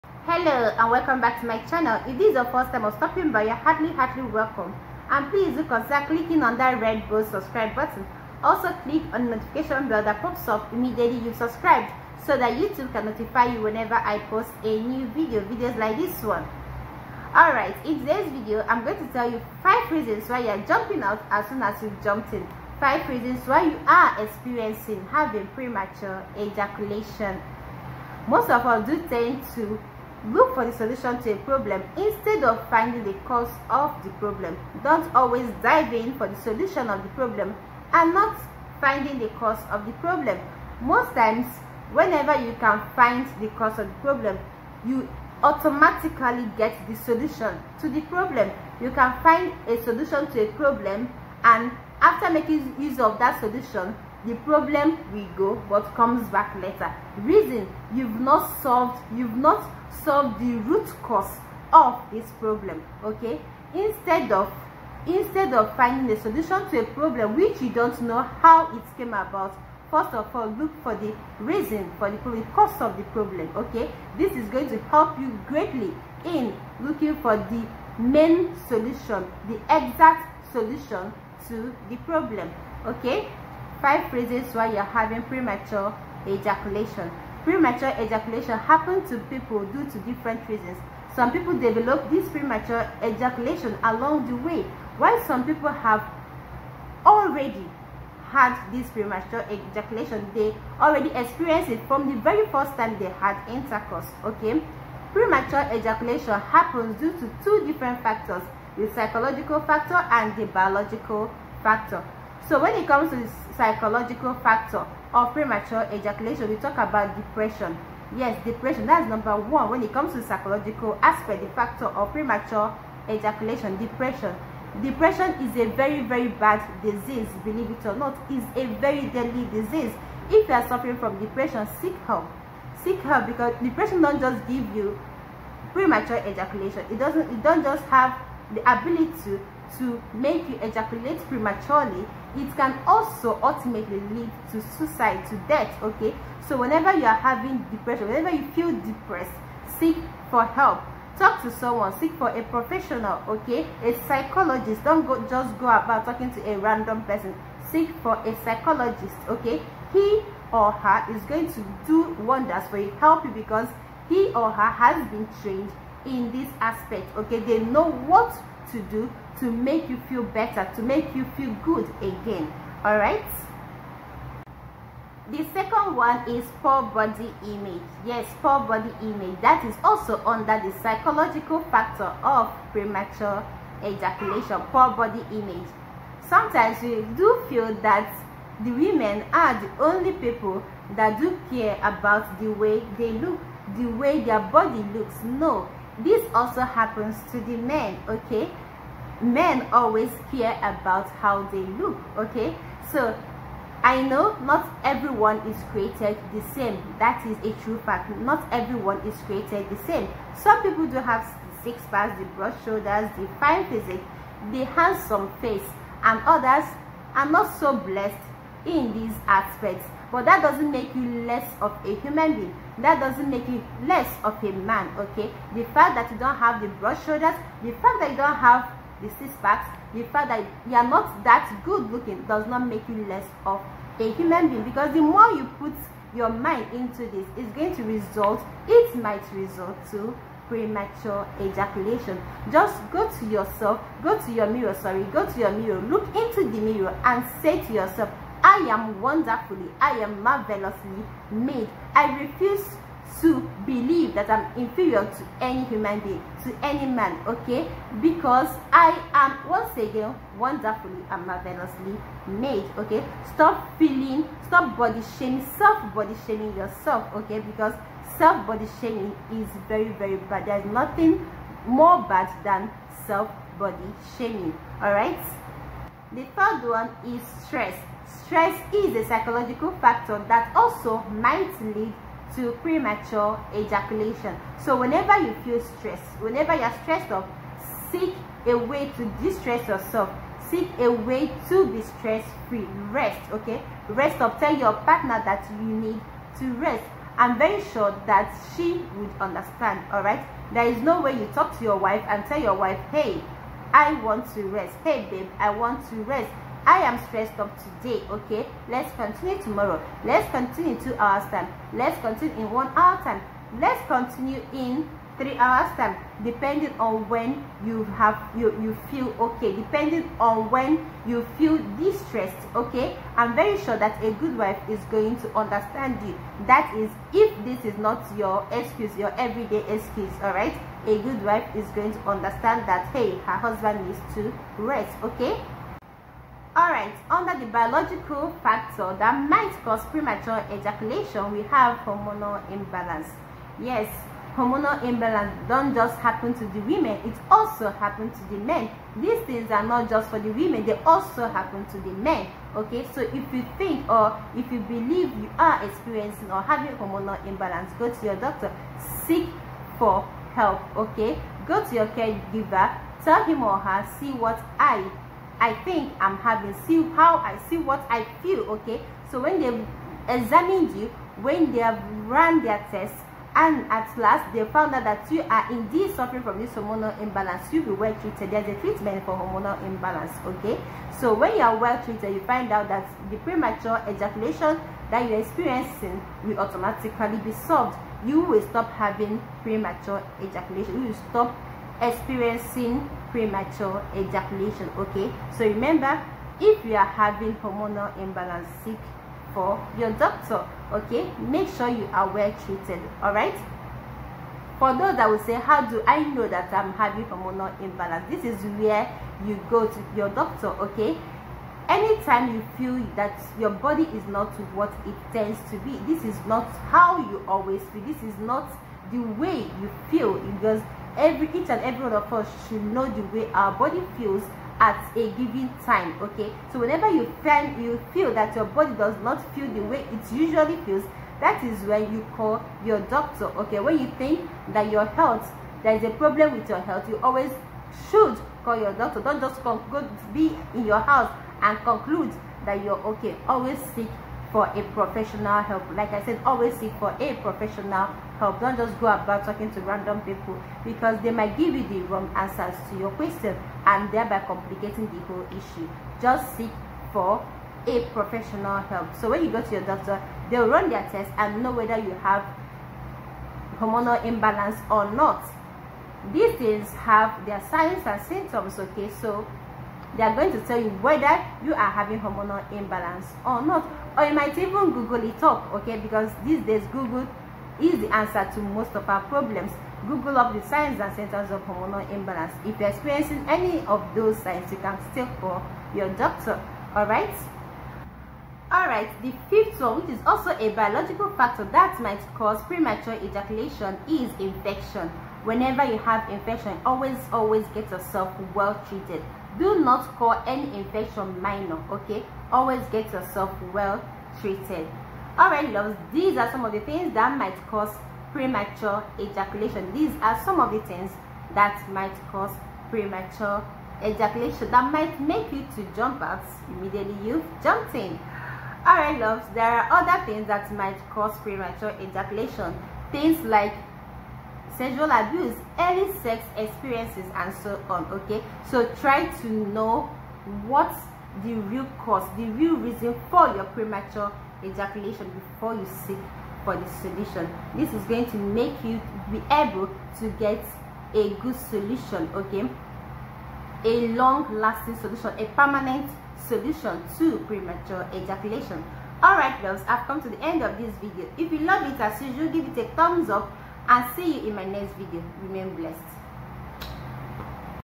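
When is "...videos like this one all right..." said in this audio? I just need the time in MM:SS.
00:15.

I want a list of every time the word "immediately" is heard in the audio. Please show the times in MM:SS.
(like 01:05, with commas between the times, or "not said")
00:10, 08:36.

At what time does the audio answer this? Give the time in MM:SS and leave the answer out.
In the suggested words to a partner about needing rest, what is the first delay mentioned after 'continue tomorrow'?
05:10.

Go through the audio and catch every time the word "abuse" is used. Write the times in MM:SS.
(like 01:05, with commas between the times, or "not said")
08:44.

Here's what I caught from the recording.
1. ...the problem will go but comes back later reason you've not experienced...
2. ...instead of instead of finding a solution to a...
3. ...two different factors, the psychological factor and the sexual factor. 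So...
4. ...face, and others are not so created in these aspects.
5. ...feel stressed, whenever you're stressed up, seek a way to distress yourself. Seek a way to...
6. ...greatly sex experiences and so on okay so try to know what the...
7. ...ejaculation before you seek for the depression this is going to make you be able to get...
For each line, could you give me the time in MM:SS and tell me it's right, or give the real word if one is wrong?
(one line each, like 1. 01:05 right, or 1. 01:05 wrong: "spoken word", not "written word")
1. 00:54 wrong: "solved", not "experienced"
2. 01:03 right
3. 01:47 wrong: "biological", not "sexual"
4. 03:35 wrong: "blessed", not "created"
5. 04:45 right
6. 08:45 wrong: "early", not "greatly"
7. 08:54 wrong: "solution", not "depression".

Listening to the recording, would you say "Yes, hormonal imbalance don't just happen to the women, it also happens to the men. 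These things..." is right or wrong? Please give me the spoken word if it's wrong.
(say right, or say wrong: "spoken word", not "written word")
right.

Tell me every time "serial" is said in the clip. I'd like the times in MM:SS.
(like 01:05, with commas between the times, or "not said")
not said.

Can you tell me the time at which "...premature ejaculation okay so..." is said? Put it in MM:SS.
06:33.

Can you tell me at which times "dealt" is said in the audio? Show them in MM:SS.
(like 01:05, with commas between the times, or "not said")
not said.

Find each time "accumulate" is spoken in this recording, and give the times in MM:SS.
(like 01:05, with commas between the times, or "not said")
not said.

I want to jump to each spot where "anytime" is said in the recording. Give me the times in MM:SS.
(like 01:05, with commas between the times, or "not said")
06:51.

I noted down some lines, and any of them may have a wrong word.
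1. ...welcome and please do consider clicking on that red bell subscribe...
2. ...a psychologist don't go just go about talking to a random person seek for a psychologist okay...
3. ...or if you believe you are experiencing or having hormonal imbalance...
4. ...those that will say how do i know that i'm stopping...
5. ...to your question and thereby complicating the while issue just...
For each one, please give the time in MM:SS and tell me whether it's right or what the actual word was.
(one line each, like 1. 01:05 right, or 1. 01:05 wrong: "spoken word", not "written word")
1. 00:04 right
2. 02:33 right
3. 05:53 right
4. 06:44 wrong: "having", not "stopping"
5. 07:32 wrong: "whole", not "while".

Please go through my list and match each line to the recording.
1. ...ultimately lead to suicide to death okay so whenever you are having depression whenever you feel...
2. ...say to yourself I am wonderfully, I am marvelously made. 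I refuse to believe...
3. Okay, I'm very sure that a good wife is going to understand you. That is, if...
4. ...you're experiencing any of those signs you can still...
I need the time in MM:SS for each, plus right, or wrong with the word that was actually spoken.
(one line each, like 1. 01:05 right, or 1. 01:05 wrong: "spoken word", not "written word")
1. 02:23 right
2. 04:07 right
3. 05:22 right
4. 08:02 right.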